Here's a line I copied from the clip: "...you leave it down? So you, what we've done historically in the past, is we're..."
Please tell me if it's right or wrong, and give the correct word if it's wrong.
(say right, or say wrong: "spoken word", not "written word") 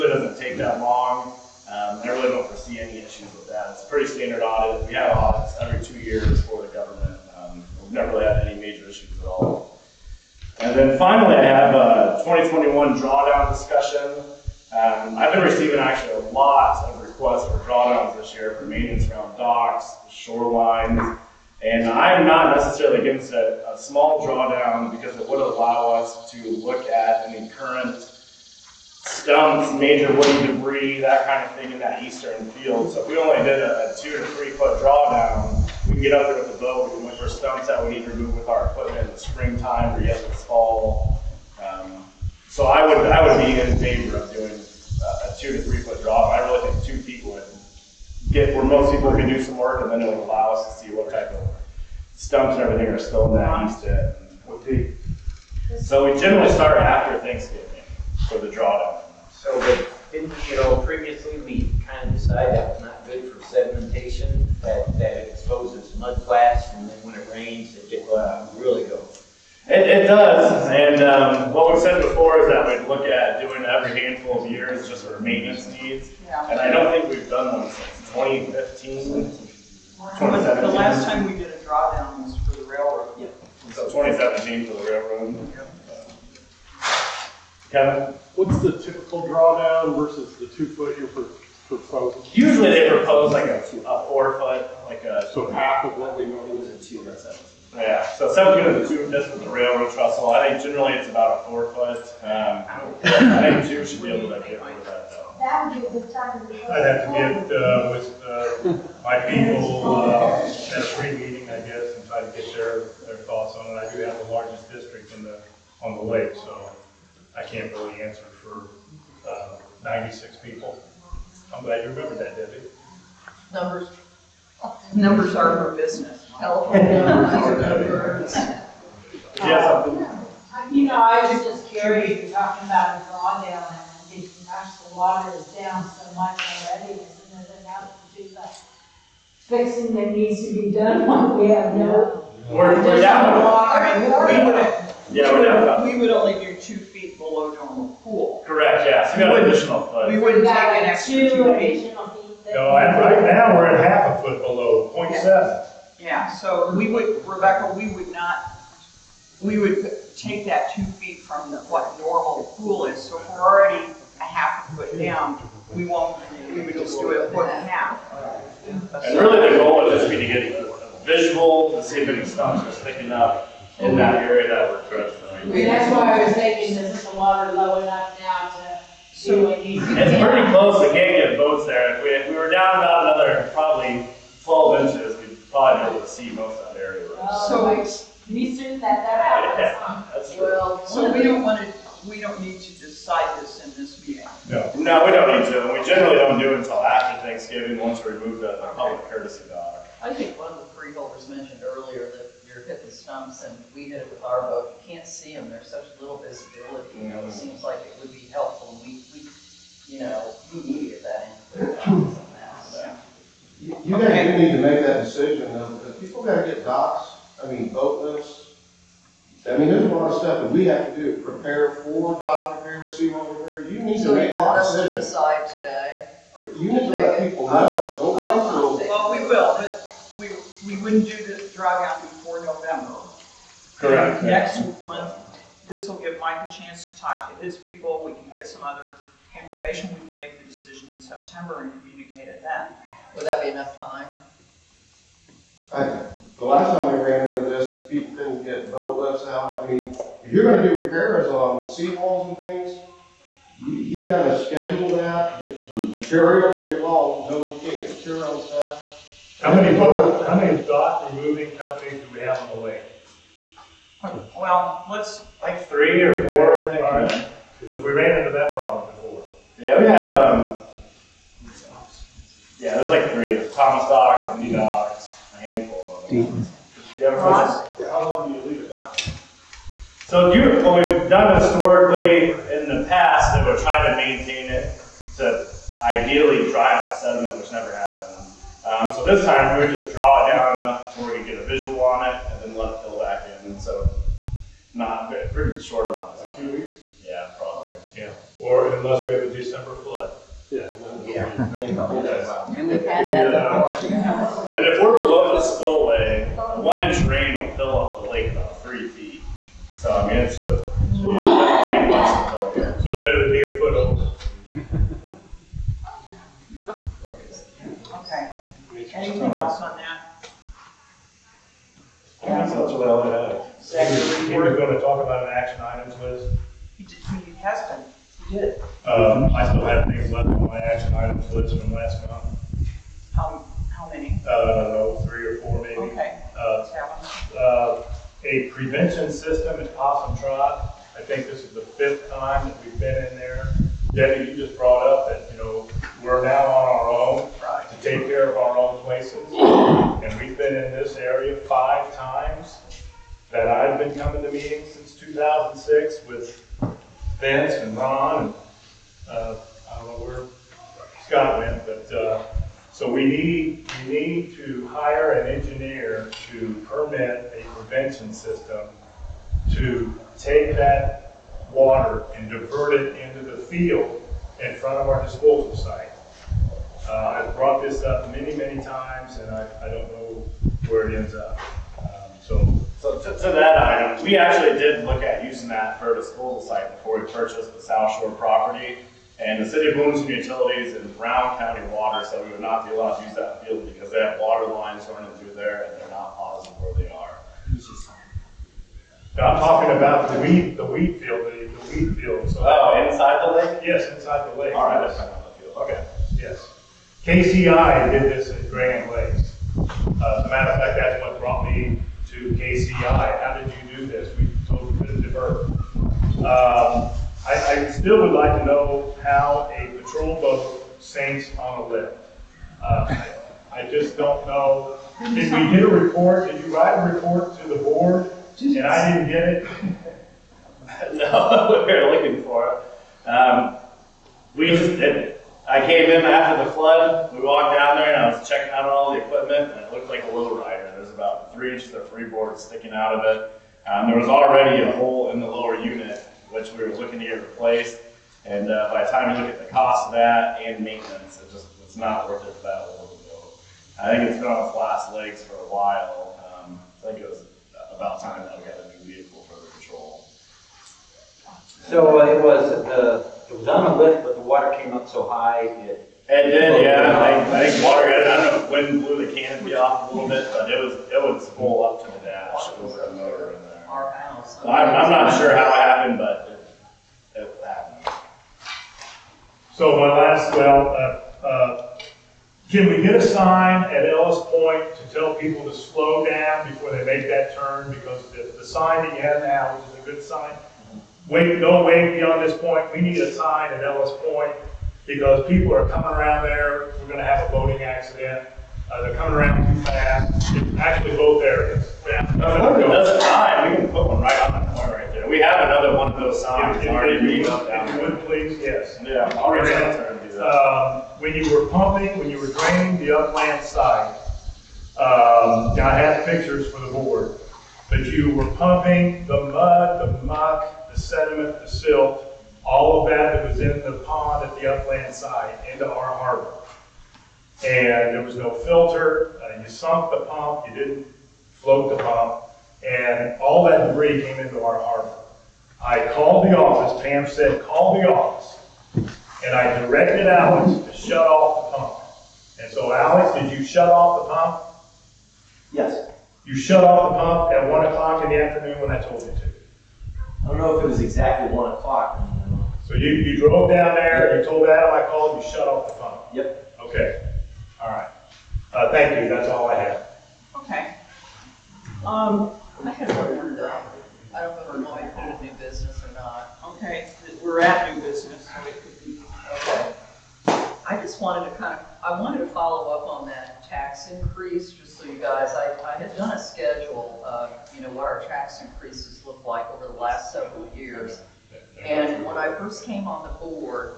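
right.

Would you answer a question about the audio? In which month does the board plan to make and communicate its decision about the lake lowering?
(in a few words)
September.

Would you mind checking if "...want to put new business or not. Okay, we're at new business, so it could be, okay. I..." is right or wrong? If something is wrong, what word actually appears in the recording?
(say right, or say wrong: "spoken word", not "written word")
right.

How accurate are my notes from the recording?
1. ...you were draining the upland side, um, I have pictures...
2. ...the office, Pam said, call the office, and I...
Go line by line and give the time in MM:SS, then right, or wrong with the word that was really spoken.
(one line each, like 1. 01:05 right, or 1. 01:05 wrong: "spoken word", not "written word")
1. 08:32 right
2. 08:56 right.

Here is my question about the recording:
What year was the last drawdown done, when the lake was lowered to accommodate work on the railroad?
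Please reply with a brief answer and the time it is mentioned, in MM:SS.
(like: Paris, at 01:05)
2017, at 01:23.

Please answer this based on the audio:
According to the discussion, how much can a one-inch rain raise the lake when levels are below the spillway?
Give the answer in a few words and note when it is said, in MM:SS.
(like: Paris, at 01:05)
about 3 feet, at 05:08.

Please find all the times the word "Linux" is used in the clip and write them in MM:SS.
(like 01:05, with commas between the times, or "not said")
not said.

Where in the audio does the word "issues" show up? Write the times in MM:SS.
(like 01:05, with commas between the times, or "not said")
00:02, 00:08.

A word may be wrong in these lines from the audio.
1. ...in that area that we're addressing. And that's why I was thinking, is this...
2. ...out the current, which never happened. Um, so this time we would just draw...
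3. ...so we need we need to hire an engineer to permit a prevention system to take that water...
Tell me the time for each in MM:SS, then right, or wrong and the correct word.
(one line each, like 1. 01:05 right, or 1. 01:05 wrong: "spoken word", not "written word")
1. 02:53 right
2. 04:46 wrong: "sediment", not "current"
3. 06:02 right.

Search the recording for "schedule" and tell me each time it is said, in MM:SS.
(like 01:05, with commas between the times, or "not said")
04:14, 09:36.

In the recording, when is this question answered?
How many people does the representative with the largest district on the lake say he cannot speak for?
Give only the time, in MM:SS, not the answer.
01:59.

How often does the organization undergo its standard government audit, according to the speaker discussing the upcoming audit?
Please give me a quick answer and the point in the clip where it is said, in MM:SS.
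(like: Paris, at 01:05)
every 2 years, at 00:05.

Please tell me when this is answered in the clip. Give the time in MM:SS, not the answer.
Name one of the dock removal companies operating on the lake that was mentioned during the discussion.
04:33.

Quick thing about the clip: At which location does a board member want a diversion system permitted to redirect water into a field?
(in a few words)
Possum Trot.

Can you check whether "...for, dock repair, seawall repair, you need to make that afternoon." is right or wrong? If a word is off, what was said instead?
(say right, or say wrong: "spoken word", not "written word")
wrong: "decision", not "afternoon".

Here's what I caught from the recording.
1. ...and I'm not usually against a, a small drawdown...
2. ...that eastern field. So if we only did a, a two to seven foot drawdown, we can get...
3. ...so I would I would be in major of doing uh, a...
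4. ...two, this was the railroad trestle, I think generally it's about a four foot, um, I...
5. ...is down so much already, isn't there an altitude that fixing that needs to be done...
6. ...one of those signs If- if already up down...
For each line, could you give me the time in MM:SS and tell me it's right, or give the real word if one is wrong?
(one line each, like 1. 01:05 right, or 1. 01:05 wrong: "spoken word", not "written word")
1. 00:21 wrong: "necessarily", not "usually"
2. 00:31 wrong: "three", not "seven"
3. 00:42 wrong: "favor", not "major"
4. 01:38 right
5. 02:15 right
6. 08:25 right.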